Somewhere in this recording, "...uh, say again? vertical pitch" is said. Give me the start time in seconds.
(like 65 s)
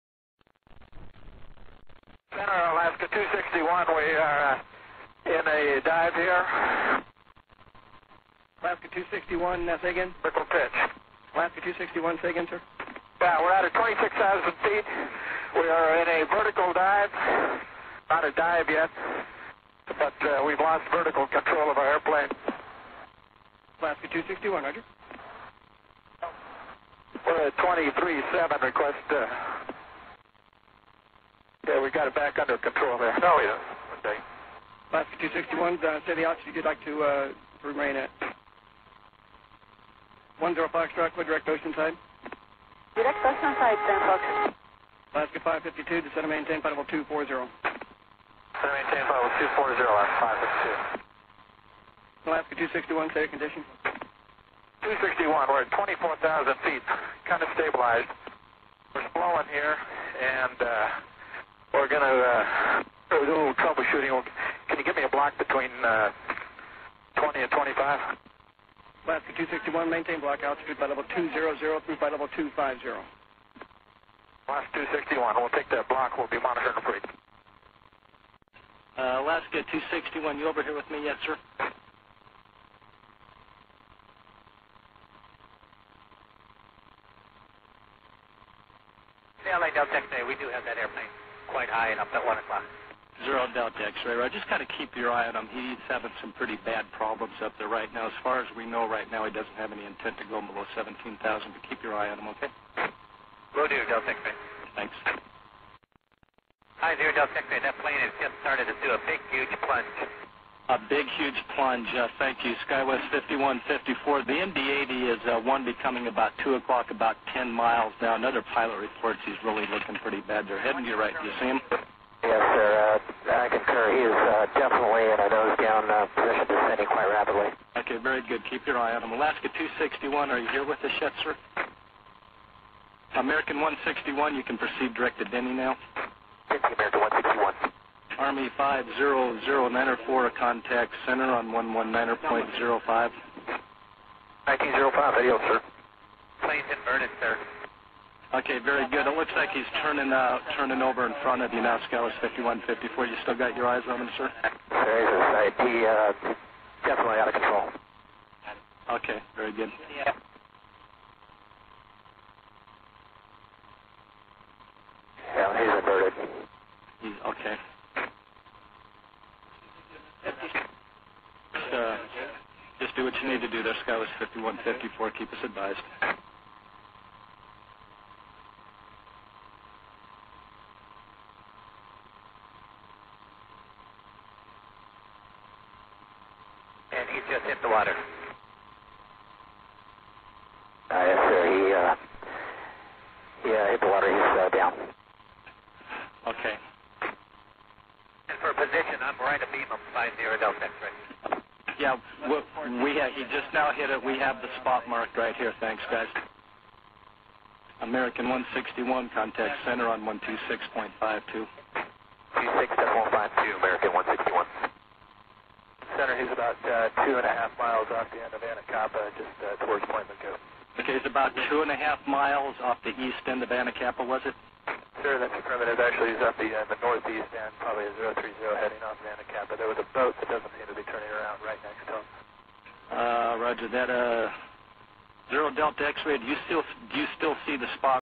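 9 s.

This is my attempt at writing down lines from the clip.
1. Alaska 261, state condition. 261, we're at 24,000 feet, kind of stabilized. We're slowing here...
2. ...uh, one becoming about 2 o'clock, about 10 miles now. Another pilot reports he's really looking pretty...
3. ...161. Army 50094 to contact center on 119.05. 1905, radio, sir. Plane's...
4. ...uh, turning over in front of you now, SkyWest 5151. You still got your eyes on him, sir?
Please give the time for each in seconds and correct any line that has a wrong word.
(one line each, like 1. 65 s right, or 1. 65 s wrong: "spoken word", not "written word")
1. 52 s right
2. 115 s right
3. 137 s right
4. 150 s wrong: "5154", not "5151".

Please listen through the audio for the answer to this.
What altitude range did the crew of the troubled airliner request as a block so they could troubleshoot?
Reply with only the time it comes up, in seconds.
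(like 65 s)
65 s.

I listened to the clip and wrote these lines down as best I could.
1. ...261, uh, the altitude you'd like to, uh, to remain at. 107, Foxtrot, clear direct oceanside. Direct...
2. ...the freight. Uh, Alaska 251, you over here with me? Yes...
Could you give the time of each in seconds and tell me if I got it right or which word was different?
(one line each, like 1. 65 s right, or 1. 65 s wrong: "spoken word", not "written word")
1. 35 s wrong: "105", not "107"
2. 76 s wrong: "261", not "251".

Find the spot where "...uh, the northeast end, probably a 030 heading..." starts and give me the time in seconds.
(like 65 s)
226 s.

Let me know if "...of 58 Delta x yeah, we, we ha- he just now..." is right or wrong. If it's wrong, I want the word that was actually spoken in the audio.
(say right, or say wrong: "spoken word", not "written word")
wrong: "50", not "58".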